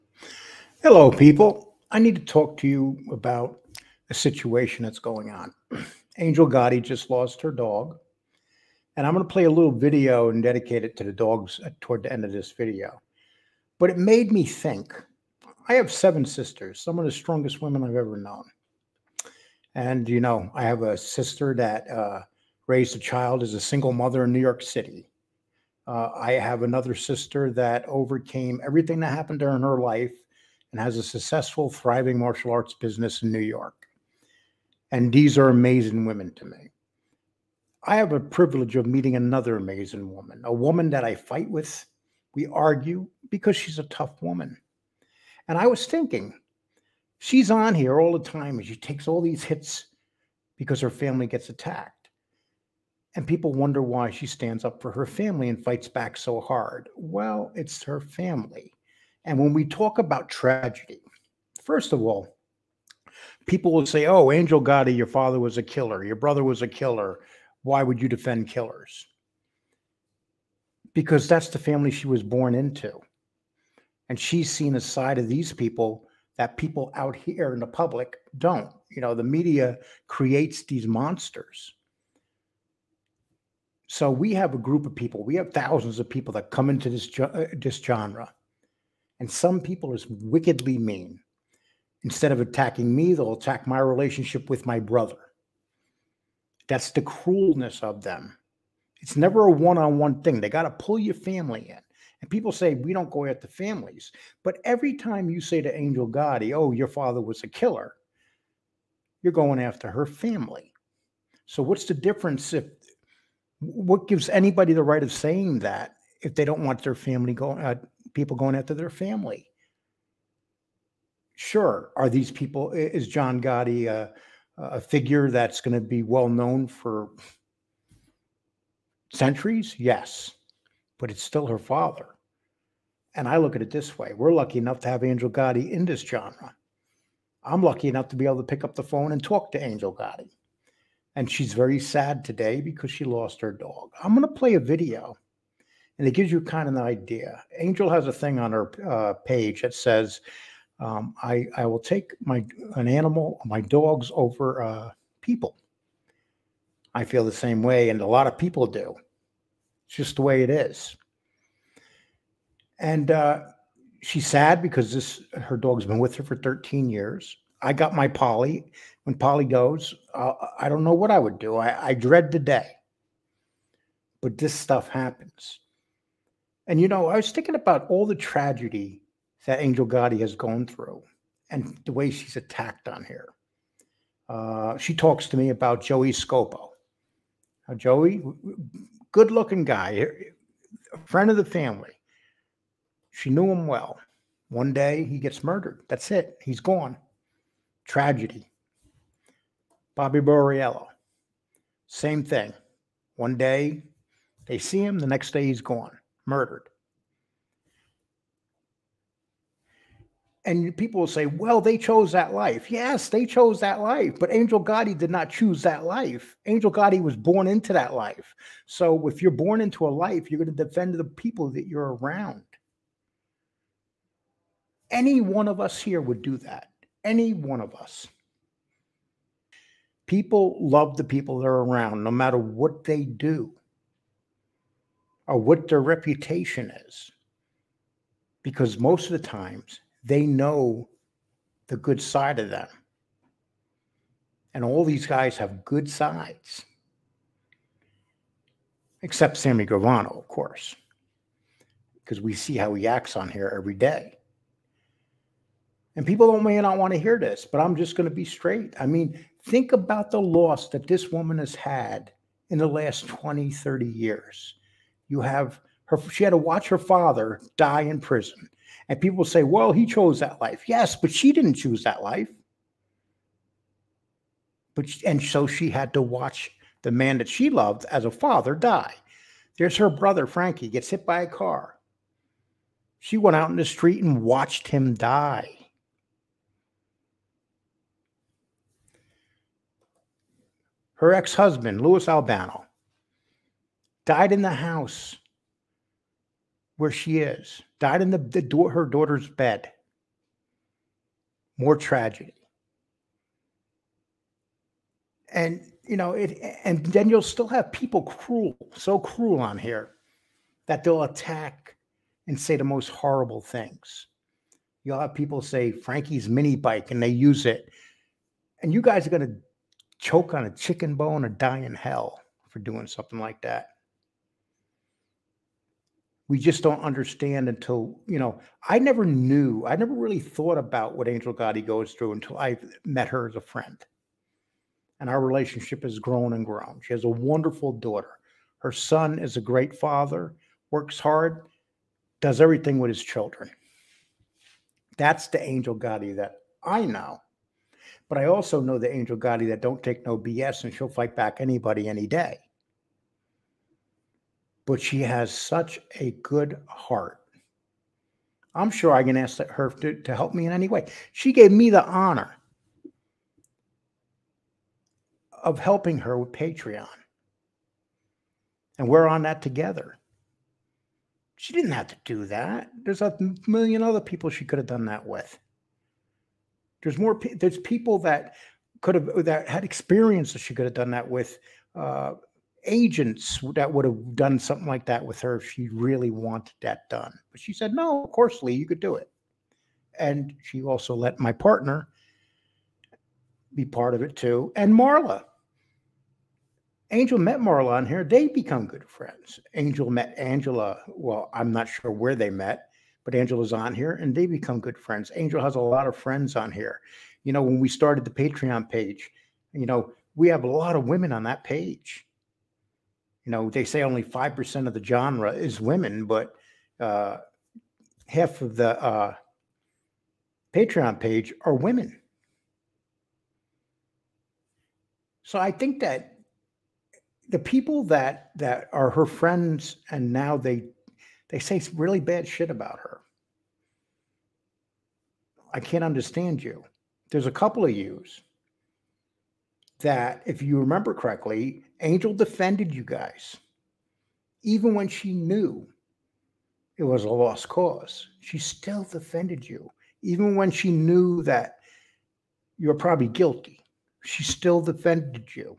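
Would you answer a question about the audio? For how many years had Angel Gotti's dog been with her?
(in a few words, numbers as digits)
13.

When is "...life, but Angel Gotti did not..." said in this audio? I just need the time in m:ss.
3:33.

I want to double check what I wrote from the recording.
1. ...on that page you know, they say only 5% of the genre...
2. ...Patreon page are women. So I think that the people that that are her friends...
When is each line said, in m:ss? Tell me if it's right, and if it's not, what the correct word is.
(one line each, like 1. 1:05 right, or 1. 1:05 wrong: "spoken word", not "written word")
1. 6:51 right
2. 7:00 right.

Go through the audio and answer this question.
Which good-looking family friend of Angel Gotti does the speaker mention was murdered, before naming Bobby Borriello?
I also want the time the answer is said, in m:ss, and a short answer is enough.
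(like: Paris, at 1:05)
Joey Scopo, at 3:05.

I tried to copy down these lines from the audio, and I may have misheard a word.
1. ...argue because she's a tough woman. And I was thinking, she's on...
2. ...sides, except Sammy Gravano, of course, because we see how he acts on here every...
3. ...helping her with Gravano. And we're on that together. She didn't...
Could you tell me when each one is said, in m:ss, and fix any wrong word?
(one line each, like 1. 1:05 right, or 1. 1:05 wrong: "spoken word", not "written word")
1. 0:42 right
2. 4:05 right
3. 6:05 wrong: "Patreon", not "Gravano".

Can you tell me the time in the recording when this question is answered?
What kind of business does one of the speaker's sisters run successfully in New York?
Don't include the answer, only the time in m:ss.
0:32.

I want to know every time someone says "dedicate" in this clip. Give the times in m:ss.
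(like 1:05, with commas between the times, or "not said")
0:10.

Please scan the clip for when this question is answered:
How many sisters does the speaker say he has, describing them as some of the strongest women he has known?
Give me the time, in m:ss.
0:15.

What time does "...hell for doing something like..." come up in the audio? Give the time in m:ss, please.
5:21.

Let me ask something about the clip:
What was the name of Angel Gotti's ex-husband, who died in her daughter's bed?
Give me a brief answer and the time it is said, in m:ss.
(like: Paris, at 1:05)
Louis Albano, at 4:51.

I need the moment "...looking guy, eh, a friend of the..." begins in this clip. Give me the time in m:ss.
3:09.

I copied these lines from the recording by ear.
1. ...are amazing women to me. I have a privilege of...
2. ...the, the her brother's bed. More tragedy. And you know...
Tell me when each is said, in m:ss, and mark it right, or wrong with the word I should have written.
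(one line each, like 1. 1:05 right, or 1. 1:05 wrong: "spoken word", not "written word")
1. 0:35 right
2. 4:58 wrong: "daughter", not "brother".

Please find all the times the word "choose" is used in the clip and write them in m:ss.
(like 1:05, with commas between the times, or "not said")
3:35, 4:31.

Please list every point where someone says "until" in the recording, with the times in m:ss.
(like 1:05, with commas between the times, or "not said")
5:27, 5:32.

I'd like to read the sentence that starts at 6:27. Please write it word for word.
But she said, no, of course, Lee, you could do it.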